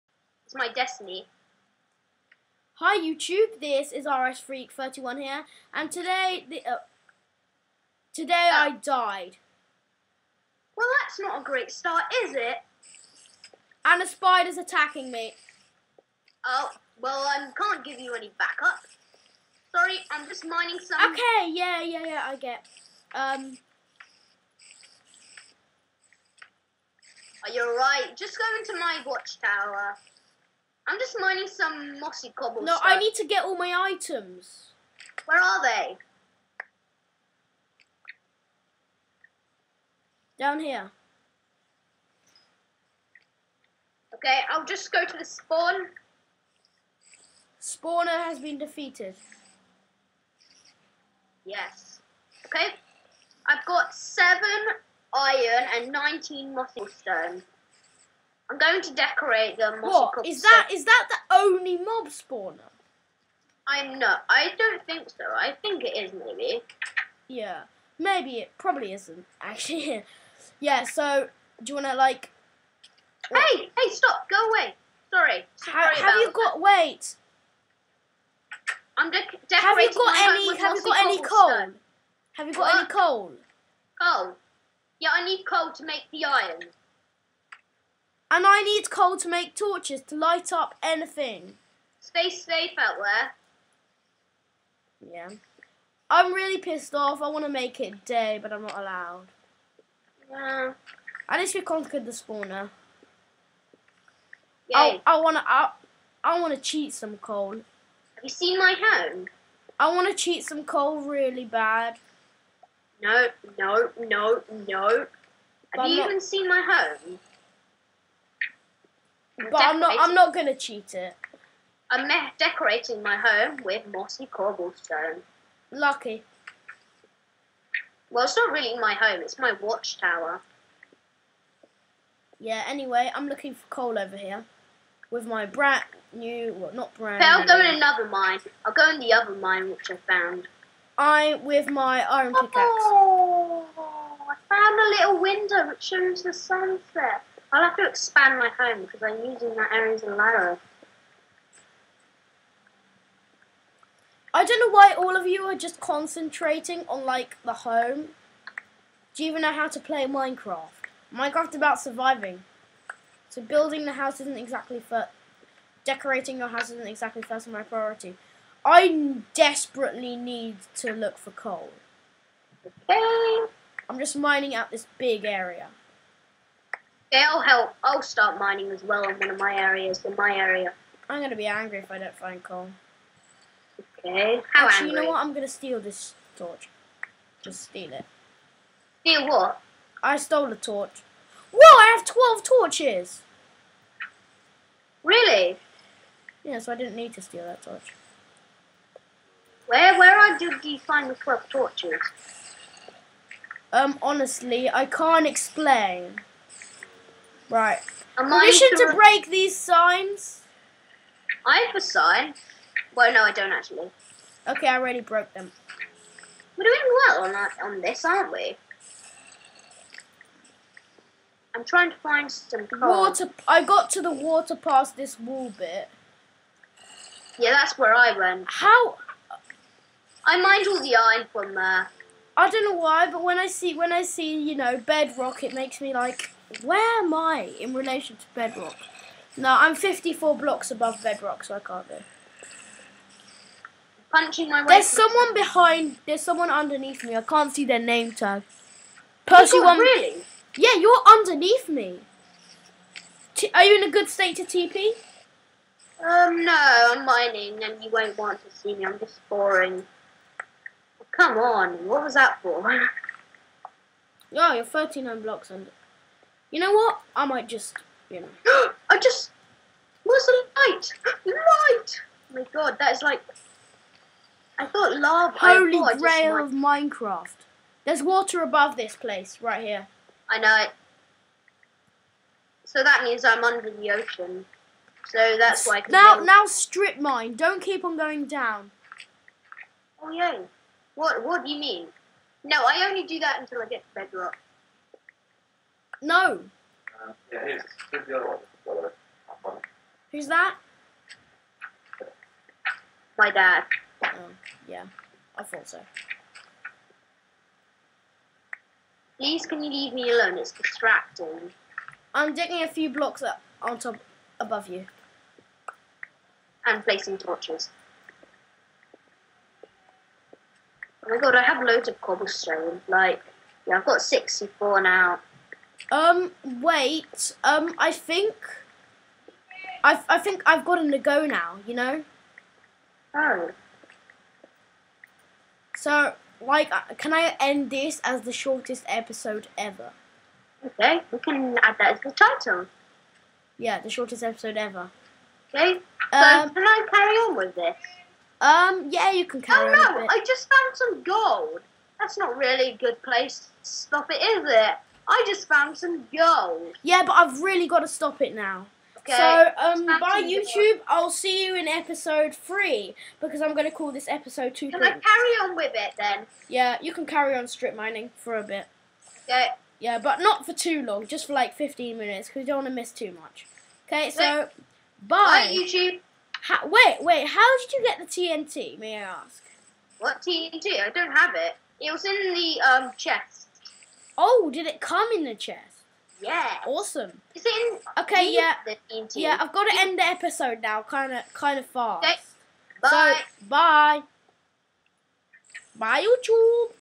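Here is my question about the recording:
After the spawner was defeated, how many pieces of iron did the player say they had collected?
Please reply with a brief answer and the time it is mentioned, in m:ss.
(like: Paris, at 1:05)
7, at 0:53.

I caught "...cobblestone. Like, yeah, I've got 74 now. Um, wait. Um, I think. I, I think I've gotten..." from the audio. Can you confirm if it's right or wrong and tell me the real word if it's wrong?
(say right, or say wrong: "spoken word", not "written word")
wrong: "64", not "74".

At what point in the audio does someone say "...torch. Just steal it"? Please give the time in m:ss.
3:06.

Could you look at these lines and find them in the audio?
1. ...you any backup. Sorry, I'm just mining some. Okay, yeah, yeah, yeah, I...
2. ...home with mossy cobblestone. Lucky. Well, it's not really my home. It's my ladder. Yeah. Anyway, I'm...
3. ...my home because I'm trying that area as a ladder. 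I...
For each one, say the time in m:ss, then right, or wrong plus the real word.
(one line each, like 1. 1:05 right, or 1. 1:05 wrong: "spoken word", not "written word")
1. 0:18 right
2. 2:03 wrong: "watchtower", not "ladder"
3. 2:28 wrong: "using", not "trying".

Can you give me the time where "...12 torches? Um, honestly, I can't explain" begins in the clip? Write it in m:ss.
3:21.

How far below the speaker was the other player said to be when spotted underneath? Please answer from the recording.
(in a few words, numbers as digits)
39 blocks.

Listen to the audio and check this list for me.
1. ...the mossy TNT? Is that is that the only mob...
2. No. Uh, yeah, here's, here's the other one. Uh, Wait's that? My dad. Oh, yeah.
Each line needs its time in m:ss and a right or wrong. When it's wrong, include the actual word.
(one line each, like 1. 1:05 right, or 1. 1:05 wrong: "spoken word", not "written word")
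1. 0:59 wrong: "What", not "TNT"
2. 4:56 wrong: "Who", not "Wait".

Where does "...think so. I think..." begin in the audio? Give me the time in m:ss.
1:04.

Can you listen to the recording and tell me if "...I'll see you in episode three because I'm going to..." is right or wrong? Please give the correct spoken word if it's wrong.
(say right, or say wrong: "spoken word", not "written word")
right.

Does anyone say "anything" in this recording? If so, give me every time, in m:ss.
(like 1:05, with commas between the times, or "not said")
1:30.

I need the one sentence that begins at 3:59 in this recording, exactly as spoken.
No, I'm 54 blocks above Bedrock, so I can't do.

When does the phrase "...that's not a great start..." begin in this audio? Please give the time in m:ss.
0:11.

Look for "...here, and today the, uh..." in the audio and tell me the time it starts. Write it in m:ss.
0:05.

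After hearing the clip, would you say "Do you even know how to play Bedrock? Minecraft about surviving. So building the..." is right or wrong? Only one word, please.
wrong.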